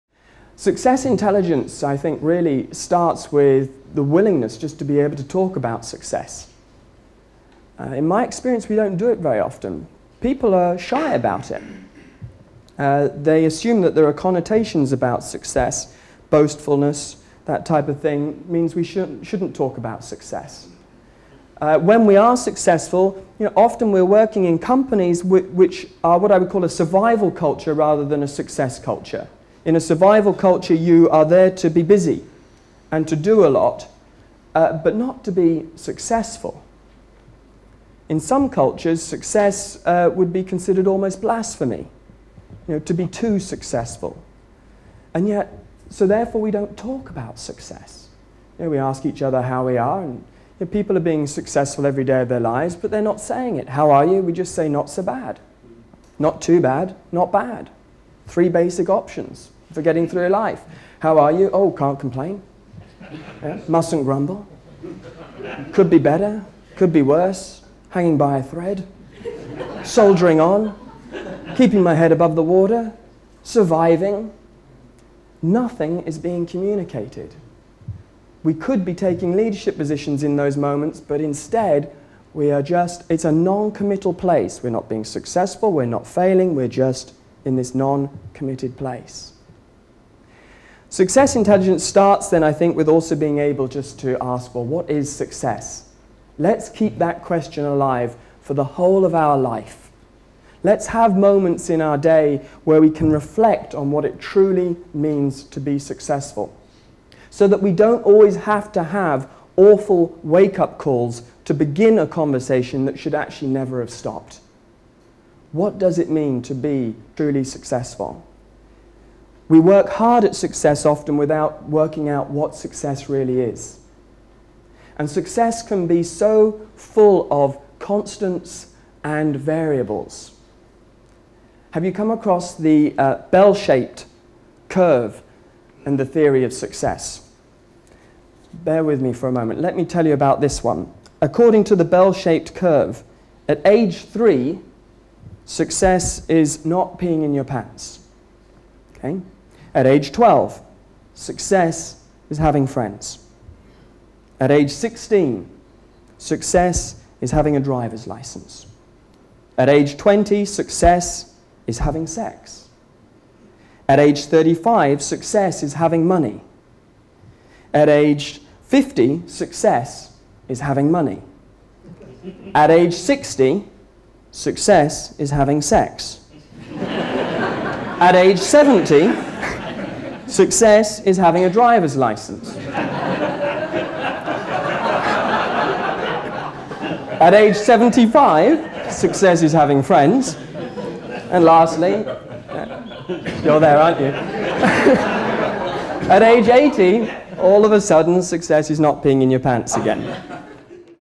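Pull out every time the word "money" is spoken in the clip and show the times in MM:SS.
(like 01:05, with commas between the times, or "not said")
02:46, 02:50.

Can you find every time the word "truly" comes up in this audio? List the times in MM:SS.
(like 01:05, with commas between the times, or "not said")
01:44, 01:57.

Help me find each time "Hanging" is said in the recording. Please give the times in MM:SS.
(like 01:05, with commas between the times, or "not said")
01:07.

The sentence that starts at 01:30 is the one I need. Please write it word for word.
Success intelligence starts then, I think, with also being able just to ask, well, what is success?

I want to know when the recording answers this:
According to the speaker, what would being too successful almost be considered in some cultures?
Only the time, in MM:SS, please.
00:41.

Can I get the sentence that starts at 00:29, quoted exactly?
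In a survival culture, you are there to be busy and to do a lot, uh, but not to be successful.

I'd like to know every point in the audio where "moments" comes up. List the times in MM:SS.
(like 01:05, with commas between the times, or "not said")
01:20, 01:41, 02:19.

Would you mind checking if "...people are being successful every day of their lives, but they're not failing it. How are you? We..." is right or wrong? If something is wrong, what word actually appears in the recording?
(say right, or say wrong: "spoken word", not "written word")
wrong: "saying", not "failing".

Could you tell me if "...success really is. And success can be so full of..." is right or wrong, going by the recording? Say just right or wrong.
right.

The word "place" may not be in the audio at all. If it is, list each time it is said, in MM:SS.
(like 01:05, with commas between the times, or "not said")
01:24, 01:28.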